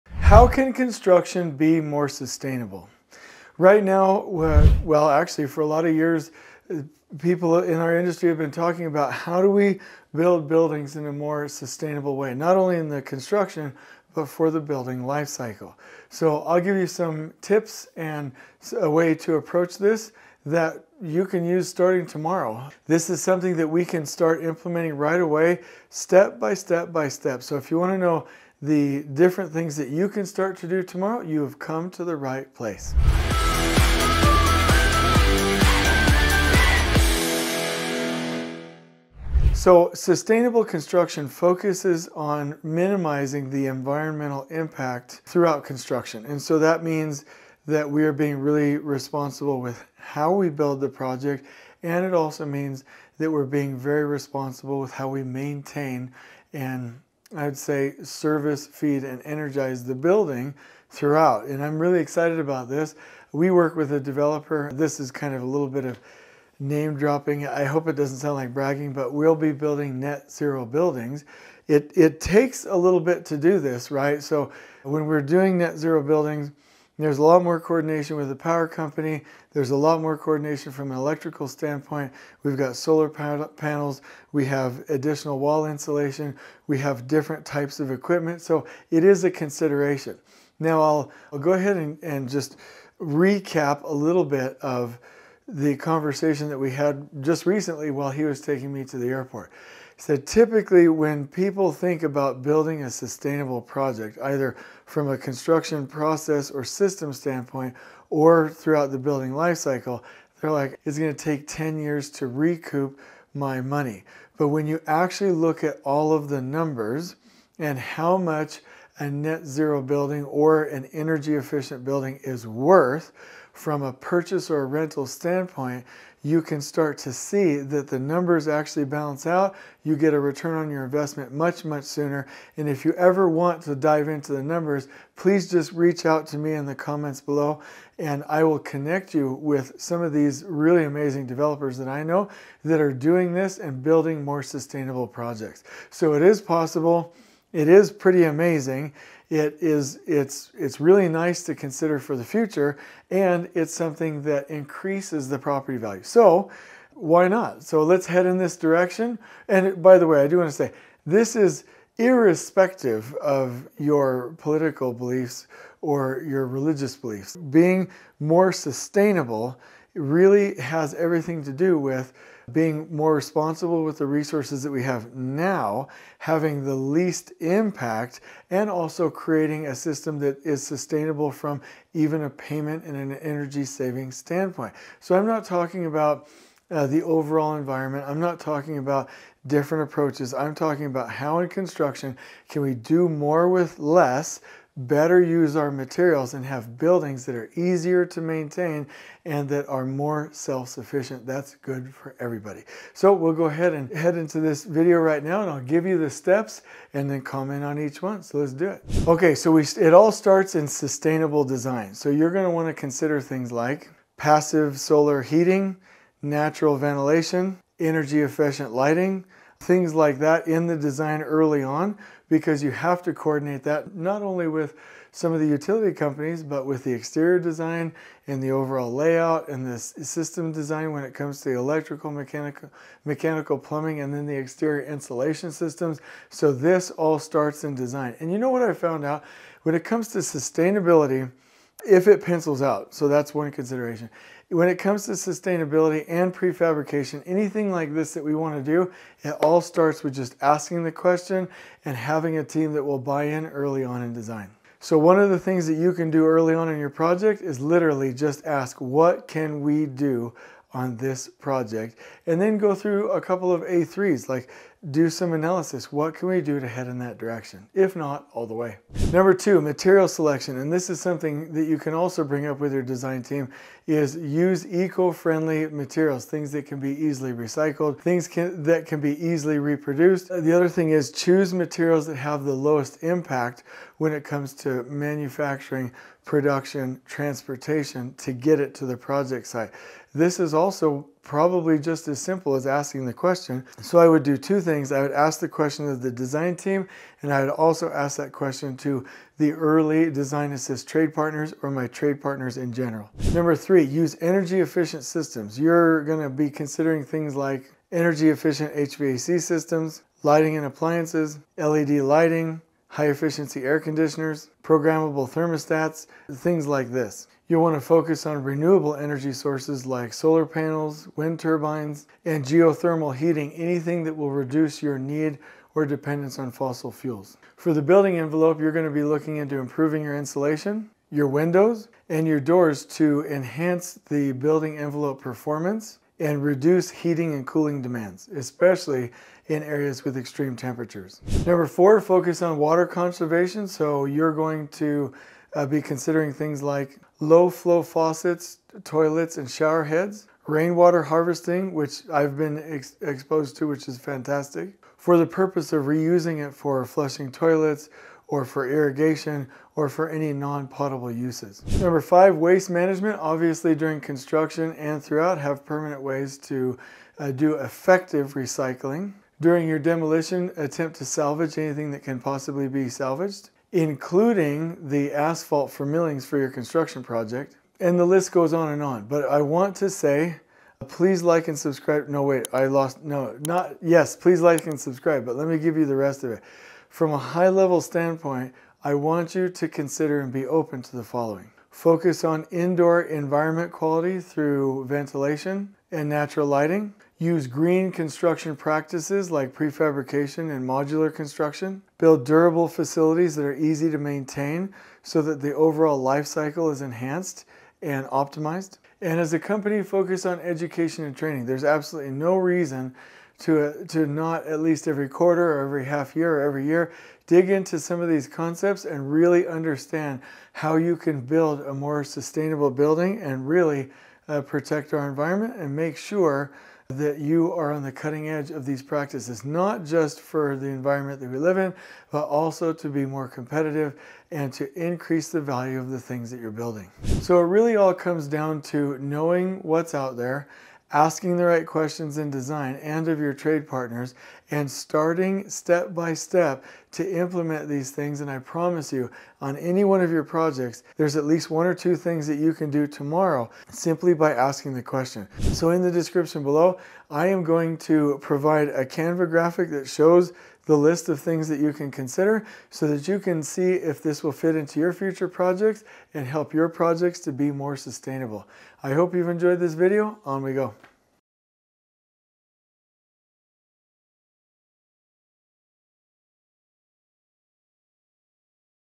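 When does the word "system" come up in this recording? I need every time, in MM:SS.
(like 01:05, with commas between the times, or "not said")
01:46, 02:59, 03:49, 03:55, 05:05, 05:09.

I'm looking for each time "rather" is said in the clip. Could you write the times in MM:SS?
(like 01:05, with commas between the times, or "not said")
not said.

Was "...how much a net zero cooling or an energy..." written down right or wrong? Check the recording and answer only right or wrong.
wrong.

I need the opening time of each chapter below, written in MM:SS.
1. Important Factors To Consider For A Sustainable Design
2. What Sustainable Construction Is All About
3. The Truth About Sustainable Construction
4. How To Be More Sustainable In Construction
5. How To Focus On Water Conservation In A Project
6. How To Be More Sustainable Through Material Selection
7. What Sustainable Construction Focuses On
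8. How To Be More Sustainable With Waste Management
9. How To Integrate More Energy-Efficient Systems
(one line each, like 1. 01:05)
1. 03:29
2. 02:39
3. 01:30
4. 06:27
5. 05:41
6. 04:29
7. 00:39
8. 06:02
9. 05:03.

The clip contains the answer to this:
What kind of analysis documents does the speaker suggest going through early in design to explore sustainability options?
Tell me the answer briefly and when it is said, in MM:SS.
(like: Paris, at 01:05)
A3s, at 04:23.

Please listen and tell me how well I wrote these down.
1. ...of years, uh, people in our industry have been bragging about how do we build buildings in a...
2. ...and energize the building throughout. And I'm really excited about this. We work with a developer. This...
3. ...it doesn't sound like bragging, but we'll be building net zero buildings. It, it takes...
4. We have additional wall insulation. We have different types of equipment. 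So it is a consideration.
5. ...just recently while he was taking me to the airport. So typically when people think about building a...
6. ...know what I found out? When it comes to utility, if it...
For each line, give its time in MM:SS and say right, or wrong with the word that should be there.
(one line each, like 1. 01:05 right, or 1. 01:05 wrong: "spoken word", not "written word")
1. 00:05 wrong: "talking", not "bragging"
2. 00:59 right
3. 01:07 right
4. 01:24 right
5. 01:37 right
6. 03:58 wrong: "sustainability", not "utility".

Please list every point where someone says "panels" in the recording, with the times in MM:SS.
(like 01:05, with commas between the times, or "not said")
01:23, 05:20.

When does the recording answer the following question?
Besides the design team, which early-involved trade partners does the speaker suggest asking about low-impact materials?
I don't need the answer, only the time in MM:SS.
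05:00.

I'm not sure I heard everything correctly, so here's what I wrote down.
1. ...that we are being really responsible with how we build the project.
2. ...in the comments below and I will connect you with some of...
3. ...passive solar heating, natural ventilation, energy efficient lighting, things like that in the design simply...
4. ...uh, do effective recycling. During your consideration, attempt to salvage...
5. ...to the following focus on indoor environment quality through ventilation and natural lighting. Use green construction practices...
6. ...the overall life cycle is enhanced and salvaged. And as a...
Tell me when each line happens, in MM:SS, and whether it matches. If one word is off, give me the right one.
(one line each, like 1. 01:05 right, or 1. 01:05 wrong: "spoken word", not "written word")
1. 00:47 right
2. 02:16 right
3. 03:34 wrong: "early", not "simply"
4. 06:07 wrong: "demolition", not "consideration"
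5. 06:30 right
6. 06:45 wrong: "optimized", not "salvaged".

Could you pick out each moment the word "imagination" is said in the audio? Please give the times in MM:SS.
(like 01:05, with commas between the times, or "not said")
not said.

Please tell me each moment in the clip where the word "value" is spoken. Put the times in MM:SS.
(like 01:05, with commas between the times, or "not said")
02:35, 07:15.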